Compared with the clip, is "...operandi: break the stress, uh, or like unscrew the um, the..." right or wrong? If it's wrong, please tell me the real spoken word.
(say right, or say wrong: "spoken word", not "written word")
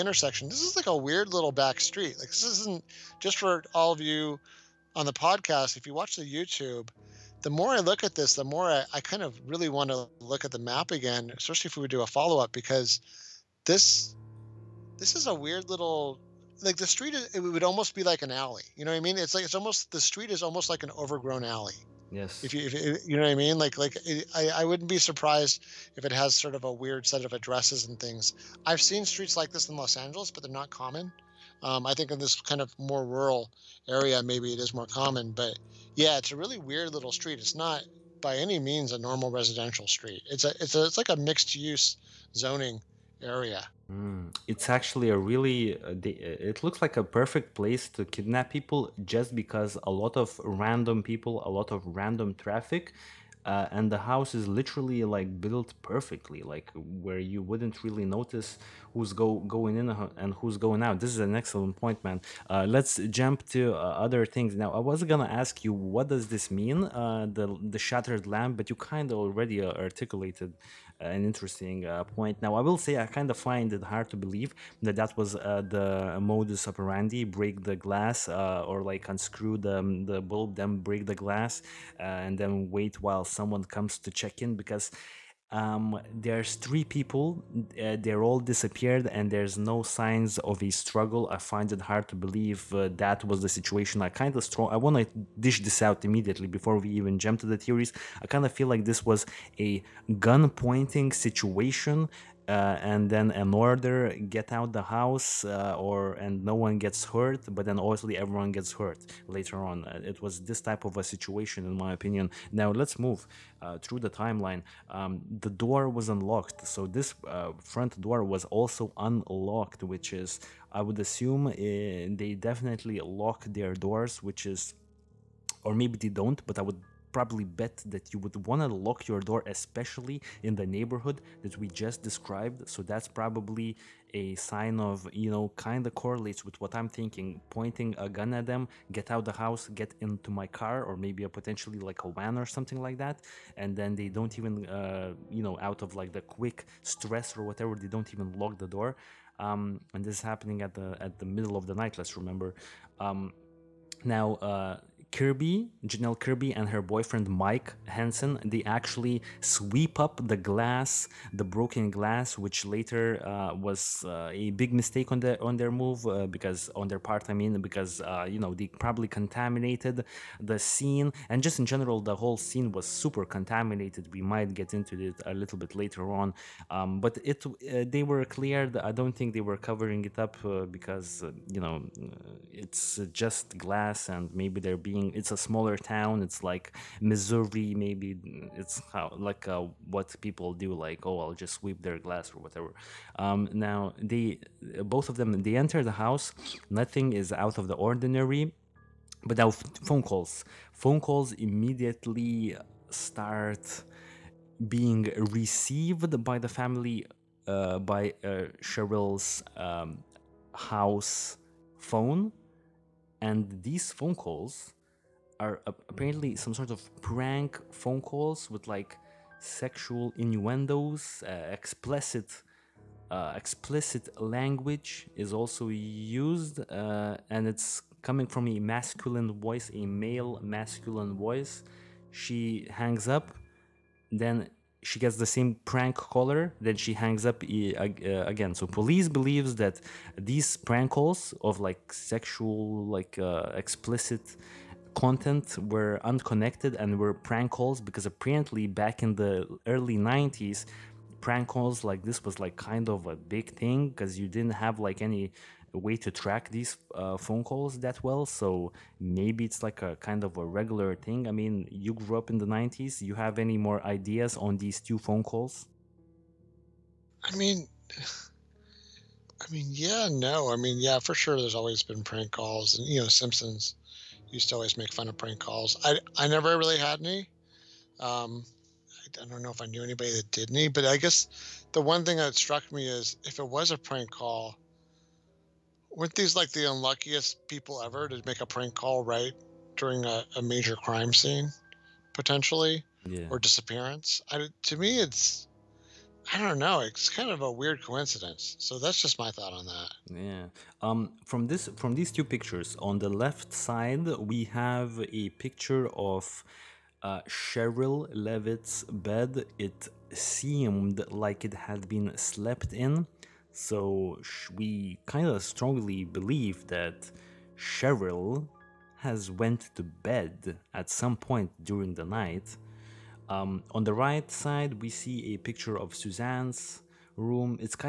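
wrong: "glass", not "stress".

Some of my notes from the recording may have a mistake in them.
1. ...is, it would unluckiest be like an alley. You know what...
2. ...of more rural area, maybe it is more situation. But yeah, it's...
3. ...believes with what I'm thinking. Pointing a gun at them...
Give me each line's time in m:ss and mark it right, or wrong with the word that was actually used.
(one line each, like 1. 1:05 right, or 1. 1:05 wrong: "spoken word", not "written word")
1. 0:17 wrong: "almost", not "unluckiest"
2. 0:32 wrong: "common", not "situation"
3. 2:16 wrong: "correlates", not "believes".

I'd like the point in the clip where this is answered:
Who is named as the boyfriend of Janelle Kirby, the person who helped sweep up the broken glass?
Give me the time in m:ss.
2:37.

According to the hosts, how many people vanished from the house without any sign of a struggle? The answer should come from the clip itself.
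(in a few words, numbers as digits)
3.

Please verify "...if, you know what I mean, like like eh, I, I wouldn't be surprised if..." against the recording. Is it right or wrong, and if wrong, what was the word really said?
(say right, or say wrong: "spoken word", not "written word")
right.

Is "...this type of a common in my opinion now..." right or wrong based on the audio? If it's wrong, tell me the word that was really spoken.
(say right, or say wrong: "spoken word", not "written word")
wrong: "situation", not "common".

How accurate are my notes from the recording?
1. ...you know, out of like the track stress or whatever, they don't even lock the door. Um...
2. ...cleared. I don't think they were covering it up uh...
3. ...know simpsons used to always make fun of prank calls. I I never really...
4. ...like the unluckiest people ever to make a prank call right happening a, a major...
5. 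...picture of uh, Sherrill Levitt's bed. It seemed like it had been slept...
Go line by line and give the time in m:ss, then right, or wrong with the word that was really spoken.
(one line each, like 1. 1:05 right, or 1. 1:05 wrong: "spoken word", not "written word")
1. 2:25 wrong: "quick", not "track"
2. 2:58 right
3. 4:33 right
4. 4:46 wrong: "during", not "happening"
5. 5:05 right.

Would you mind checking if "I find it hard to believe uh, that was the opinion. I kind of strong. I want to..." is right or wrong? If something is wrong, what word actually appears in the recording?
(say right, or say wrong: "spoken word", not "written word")
wrong: "situation", not "opinion".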